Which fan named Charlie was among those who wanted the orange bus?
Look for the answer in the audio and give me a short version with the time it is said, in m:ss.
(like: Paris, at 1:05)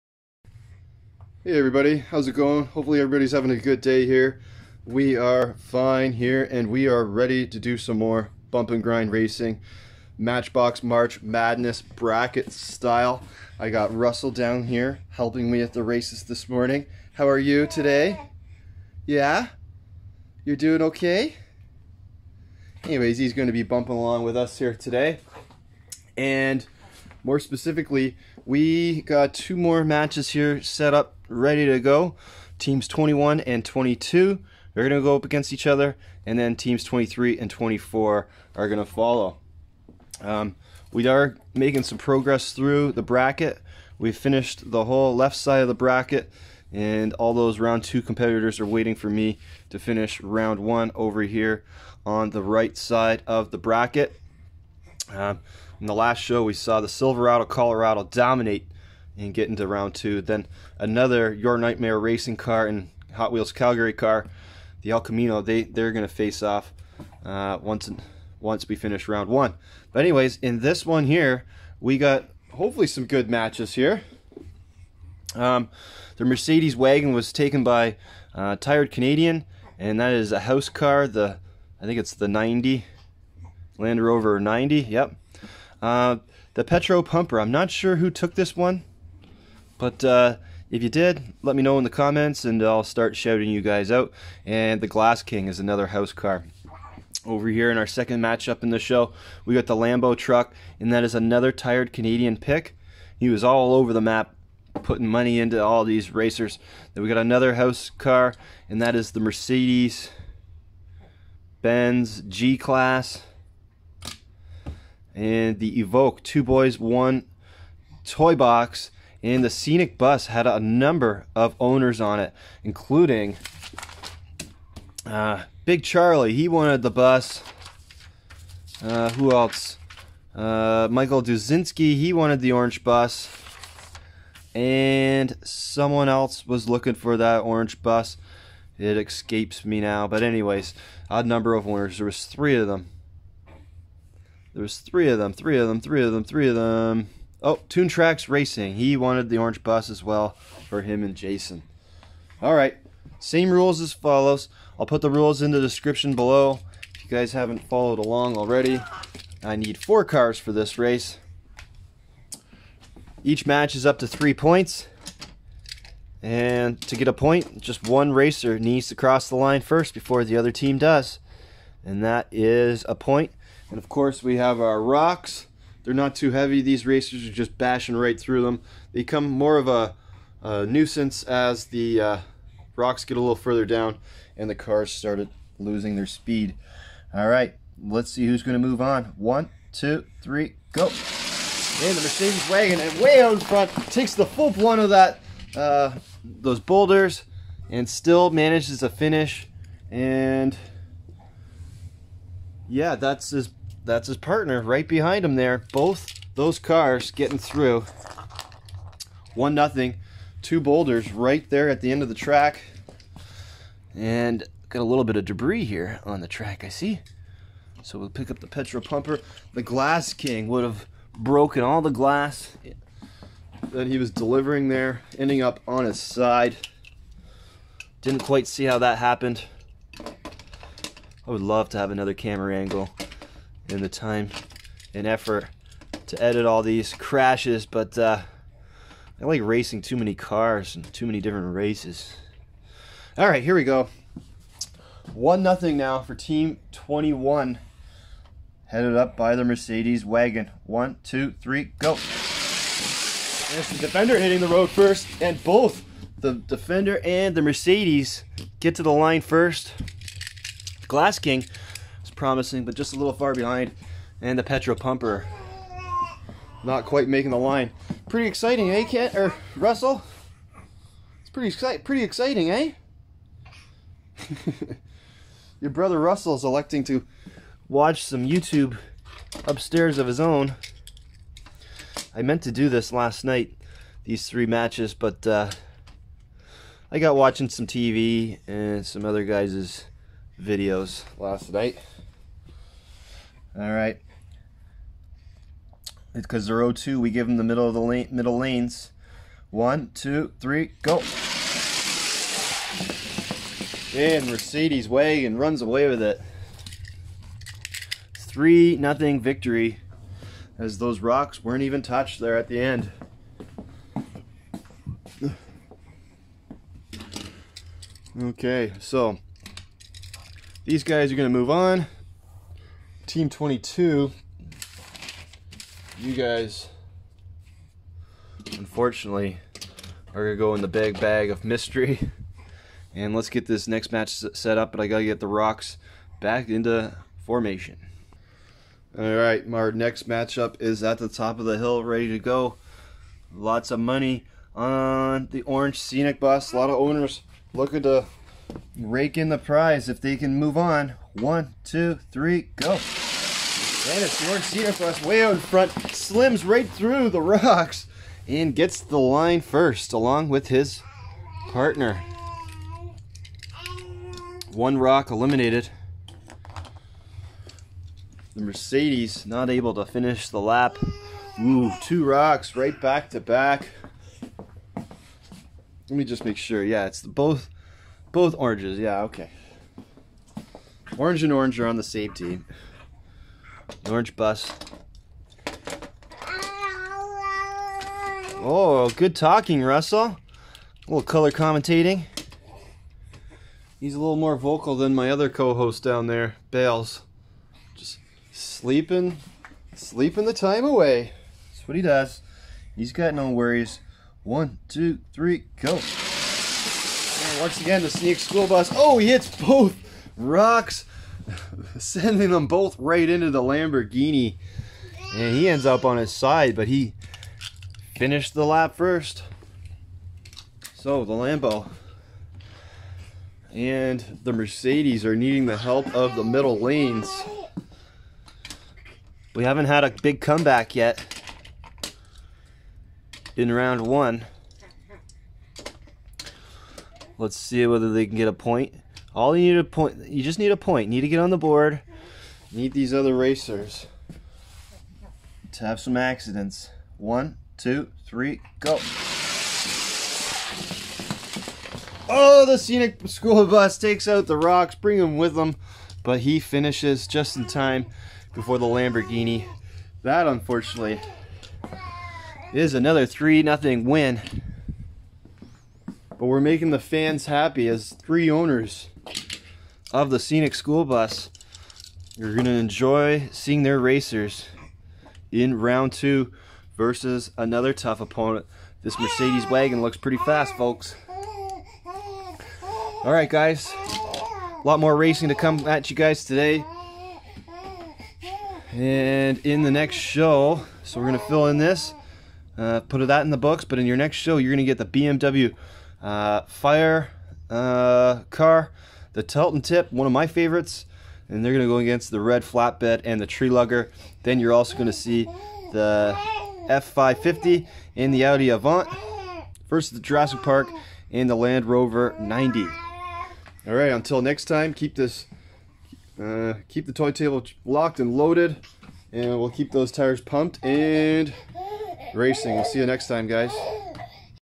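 Big Charlie, at 2:05.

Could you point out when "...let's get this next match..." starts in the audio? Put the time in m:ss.
5:33.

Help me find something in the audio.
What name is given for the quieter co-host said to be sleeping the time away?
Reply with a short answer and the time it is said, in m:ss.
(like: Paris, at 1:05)
Bales, at 6:36.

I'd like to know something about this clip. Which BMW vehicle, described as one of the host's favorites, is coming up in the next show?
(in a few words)
Telton Tip.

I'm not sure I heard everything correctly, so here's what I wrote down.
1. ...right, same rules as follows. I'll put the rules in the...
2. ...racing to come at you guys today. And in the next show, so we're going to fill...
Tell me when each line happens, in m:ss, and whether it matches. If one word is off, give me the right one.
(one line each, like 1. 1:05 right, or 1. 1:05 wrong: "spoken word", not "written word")
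1. 2:32 right
2. 8:04 right.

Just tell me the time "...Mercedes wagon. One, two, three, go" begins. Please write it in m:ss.
4:09.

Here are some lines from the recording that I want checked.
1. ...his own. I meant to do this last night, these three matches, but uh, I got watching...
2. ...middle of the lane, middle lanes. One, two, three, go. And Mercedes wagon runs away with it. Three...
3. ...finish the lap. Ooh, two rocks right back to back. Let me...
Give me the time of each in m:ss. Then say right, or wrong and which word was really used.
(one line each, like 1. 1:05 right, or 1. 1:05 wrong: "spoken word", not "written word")
1. 4:40 right
2. 4:57 right
3. 6:09 right.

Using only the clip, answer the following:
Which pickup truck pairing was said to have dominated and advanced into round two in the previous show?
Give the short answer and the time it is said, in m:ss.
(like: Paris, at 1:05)
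Silverado Colorado, at 0:56.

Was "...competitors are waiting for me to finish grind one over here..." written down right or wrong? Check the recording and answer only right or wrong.
wrong.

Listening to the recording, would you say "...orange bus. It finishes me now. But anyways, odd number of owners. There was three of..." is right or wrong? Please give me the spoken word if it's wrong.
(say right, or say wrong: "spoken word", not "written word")
wrong: "escapes", not "finishes".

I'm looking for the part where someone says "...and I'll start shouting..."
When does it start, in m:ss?
1:32.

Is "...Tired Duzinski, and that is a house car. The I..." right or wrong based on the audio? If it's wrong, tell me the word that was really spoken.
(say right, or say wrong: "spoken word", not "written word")
wrong: "Canadian", not "Duzinski".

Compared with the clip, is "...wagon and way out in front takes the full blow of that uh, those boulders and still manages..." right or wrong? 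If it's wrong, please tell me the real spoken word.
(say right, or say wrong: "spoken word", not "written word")
right.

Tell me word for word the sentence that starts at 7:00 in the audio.
So the Lambo and the Mercedes are needing the help of the middle lanes.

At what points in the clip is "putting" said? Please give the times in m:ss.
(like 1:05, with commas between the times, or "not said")
1:44.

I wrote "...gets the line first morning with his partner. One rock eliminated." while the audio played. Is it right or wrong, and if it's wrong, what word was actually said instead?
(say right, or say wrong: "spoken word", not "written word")
wrong: "along", not "morning".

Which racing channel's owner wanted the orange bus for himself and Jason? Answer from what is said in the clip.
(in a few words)
Toon Tracks Racing.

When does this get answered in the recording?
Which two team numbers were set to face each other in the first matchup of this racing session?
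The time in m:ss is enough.
0:32.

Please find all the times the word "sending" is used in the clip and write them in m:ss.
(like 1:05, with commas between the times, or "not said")
6:51.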